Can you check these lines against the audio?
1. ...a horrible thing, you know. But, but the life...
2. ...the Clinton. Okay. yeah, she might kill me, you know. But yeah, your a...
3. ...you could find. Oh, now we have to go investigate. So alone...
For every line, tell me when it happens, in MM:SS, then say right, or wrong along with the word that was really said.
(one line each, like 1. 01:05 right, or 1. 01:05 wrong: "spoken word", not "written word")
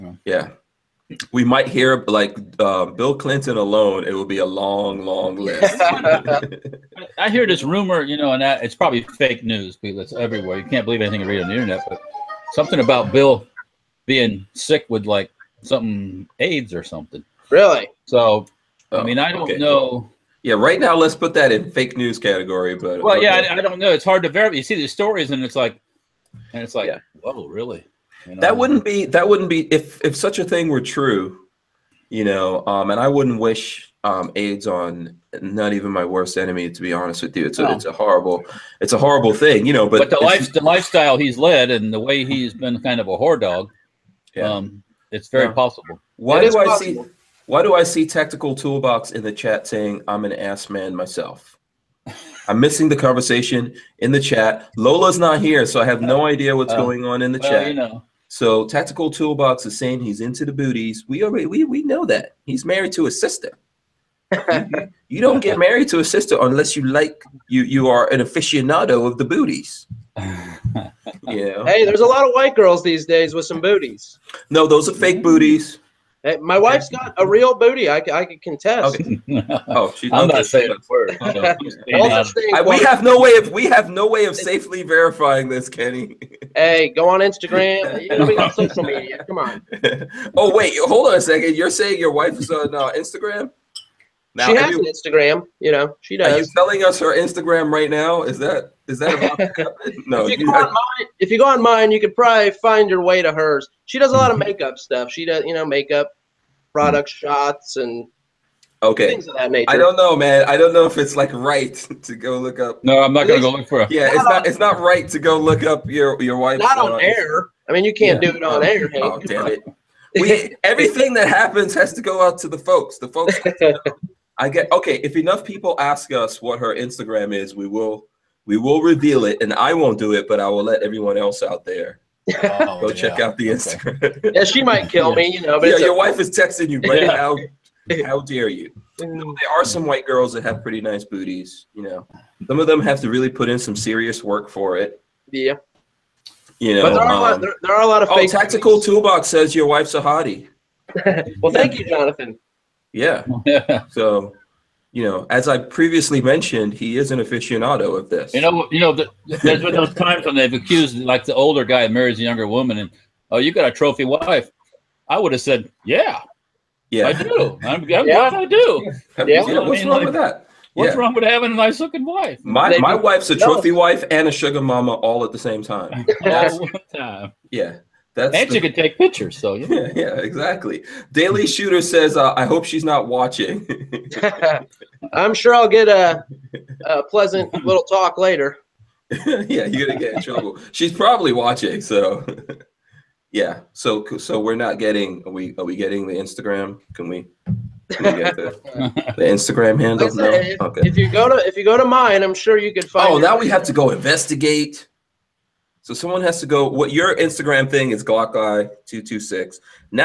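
1. 00:38 right
2. 02:13 wrong: "Instagram", not "Clinton"
3. 03:22 wrong: "someone", not "alone".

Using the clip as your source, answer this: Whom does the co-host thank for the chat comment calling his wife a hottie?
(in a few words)
Jonathan.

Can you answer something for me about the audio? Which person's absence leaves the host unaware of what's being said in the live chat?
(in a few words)
Lola.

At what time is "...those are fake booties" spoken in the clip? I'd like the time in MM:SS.
01:14.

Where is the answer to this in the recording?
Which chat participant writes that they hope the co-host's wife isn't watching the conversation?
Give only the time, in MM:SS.
03:01.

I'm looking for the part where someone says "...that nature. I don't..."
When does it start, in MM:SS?
01:49.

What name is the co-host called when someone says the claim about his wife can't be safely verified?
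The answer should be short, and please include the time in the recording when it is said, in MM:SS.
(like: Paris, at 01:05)
Kenny, at 01:25.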